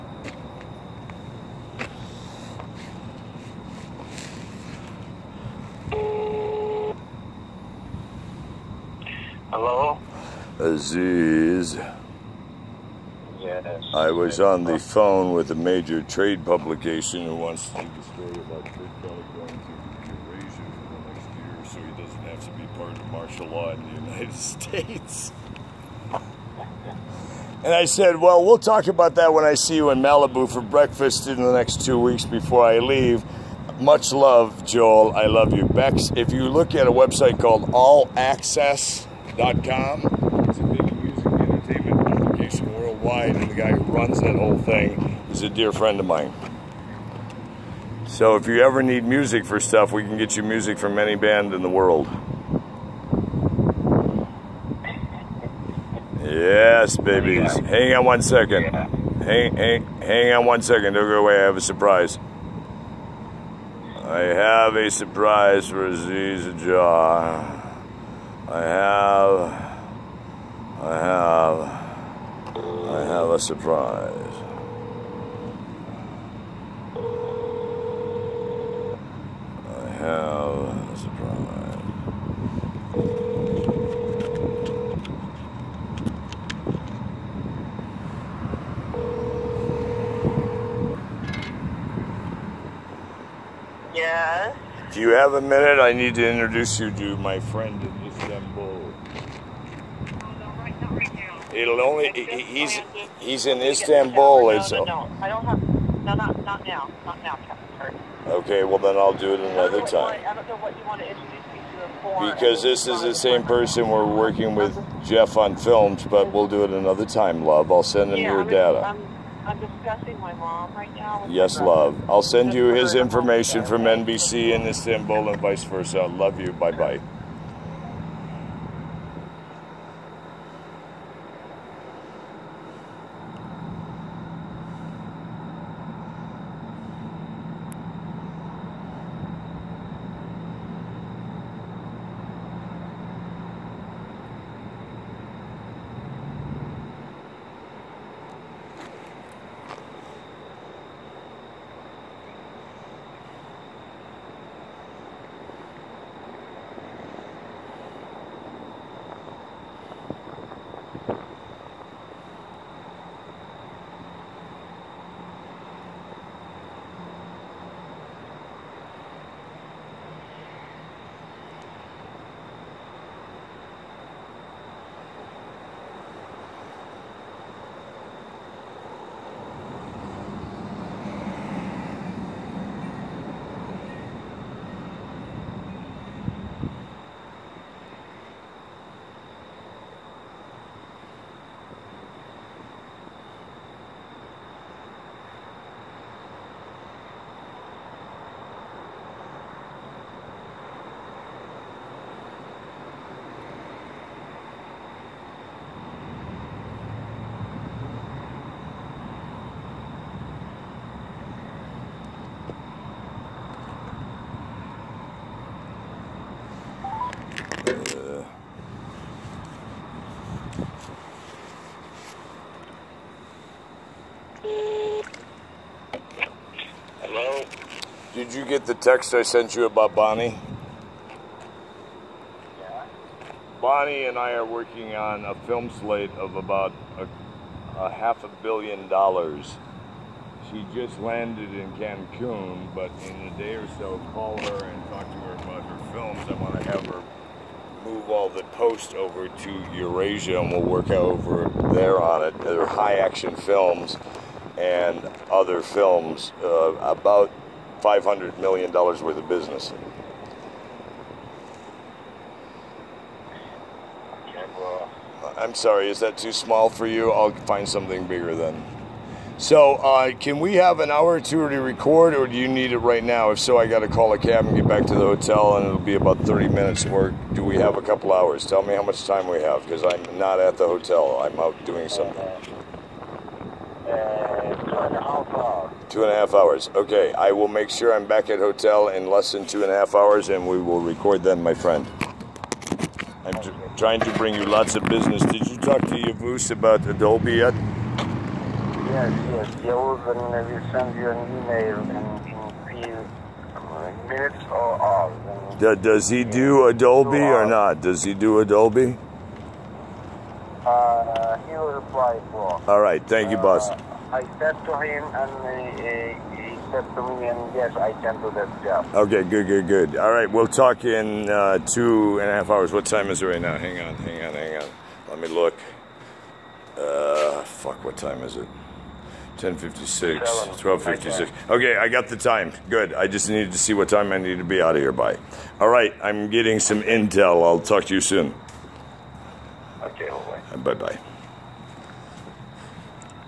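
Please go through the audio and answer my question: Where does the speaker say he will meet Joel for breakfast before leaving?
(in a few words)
Malibu.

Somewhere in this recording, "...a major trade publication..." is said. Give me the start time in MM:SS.
00:15.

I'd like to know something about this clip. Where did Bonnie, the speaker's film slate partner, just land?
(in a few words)
Cancun.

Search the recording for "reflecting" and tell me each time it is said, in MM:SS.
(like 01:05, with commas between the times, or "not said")
not said.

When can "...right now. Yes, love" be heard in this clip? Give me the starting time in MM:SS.
02:00.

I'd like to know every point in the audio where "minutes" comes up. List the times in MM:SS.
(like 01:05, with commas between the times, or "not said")
01:35, 04:36, 05:04.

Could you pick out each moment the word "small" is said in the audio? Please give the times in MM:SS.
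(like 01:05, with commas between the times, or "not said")
04:26.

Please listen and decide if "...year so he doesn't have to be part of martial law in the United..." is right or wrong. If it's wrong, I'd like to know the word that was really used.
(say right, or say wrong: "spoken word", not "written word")
right.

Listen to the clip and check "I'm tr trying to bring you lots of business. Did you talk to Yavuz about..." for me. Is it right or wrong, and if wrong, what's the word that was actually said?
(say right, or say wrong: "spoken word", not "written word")
right.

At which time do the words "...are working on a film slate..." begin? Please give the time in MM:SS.
03:54.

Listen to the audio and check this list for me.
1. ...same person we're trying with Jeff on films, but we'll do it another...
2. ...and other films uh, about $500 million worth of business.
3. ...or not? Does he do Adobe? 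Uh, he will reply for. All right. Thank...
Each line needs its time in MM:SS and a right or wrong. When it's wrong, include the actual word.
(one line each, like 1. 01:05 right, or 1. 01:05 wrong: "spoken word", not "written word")
1. 01:53 wrong: "working", not "trying"
2. 04:14 right
3. 05:07 right.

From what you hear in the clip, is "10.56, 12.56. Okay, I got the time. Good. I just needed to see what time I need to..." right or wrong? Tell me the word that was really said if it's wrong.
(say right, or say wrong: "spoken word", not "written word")
right.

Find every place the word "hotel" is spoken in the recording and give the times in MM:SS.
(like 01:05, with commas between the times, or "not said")
04:35, 04:40, 04:48.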